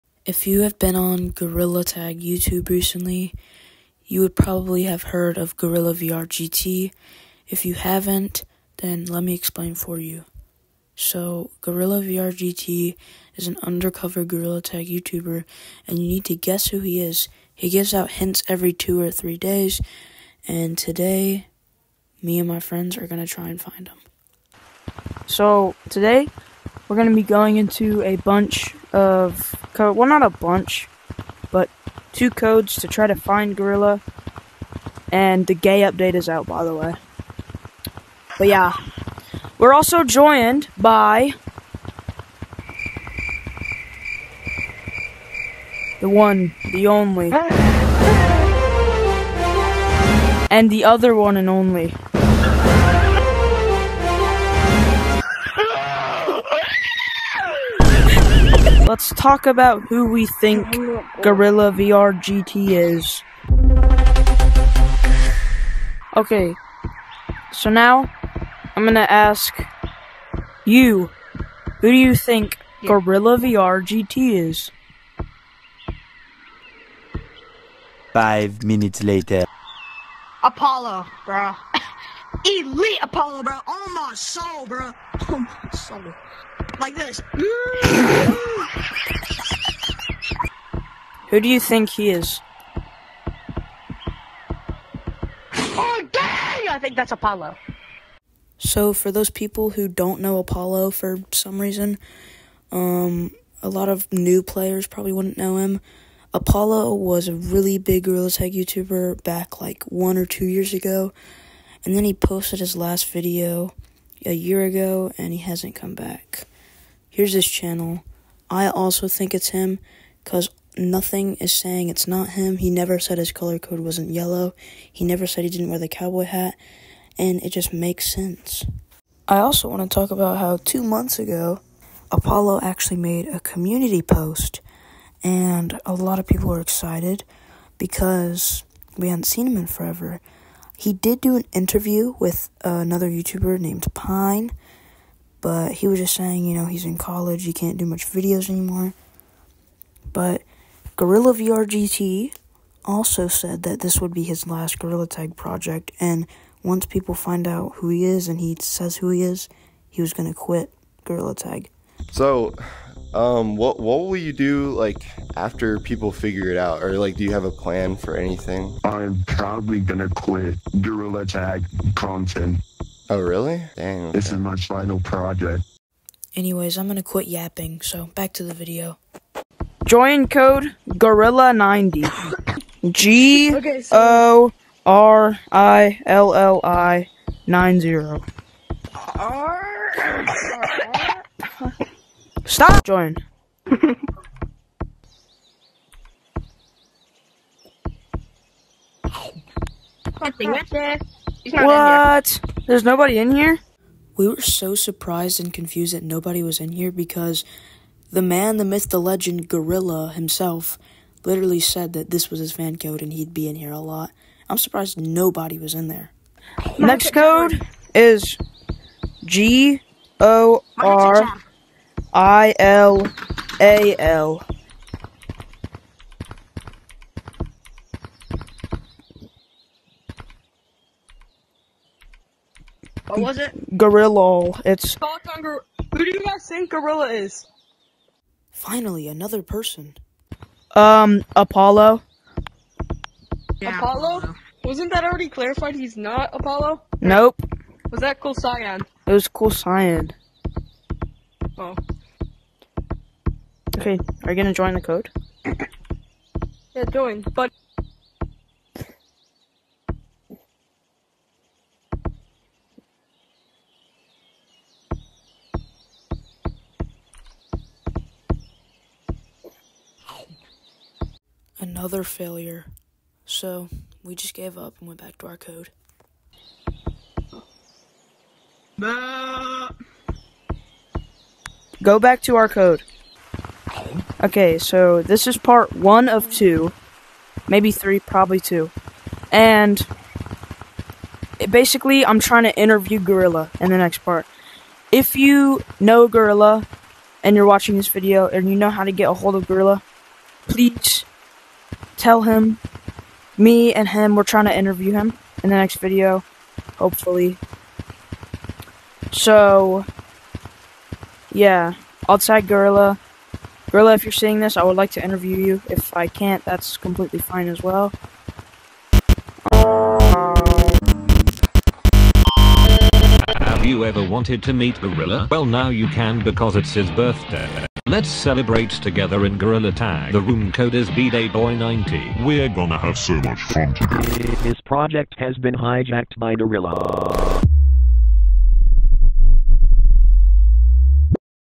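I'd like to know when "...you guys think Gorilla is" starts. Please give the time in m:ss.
3:56.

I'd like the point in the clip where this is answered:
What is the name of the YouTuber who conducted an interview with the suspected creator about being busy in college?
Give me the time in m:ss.
2:23.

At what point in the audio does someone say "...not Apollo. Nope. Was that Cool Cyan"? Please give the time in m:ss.
4:05.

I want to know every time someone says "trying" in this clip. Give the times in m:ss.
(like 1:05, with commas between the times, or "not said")
4:52, 5:04.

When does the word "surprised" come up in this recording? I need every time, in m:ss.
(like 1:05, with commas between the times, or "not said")
3:24, 3:34.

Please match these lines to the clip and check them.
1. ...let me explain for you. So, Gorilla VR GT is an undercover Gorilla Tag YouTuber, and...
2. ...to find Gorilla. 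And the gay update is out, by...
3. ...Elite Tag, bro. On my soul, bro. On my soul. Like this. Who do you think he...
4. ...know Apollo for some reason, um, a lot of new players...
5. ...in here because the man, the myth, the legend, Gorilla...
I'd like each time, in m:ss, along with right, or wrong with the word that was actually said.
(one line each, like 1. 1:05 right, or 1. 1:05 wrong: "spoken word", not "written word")
1. 0:09 right
2. 0:33 right
3. 1:22 wrong: "Apollo", not "Tag"
4. 1:40 right
5. 3:26 right.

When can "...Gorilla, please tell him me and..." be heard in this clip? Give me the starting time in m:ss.
4:59.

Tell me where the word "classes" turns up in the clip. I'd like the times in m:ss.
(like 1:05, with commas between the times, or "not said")
not said.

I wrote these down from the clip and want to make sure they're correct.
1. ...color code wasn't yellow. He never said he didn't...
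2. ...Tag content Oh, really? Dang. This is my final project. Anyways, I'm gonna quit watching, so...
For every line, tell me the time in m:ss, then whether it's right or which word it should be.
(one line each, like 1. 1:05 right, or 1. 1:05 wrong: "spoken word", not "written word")
1. 2:03 right
2. 2:51 wrong: "yapping", not "watching".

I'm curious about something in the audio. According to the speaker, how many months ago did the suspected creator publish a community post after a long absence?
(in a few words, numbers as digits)
2 months.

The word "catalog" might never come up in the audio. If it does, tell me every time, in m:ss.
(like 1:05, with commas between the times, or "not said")
not said.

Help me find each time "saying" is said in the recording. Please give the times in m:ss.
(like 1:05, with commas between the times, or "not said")
2:01, 2:26.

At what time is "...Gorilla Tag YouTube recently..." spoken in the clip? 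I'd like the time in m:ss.
0:01.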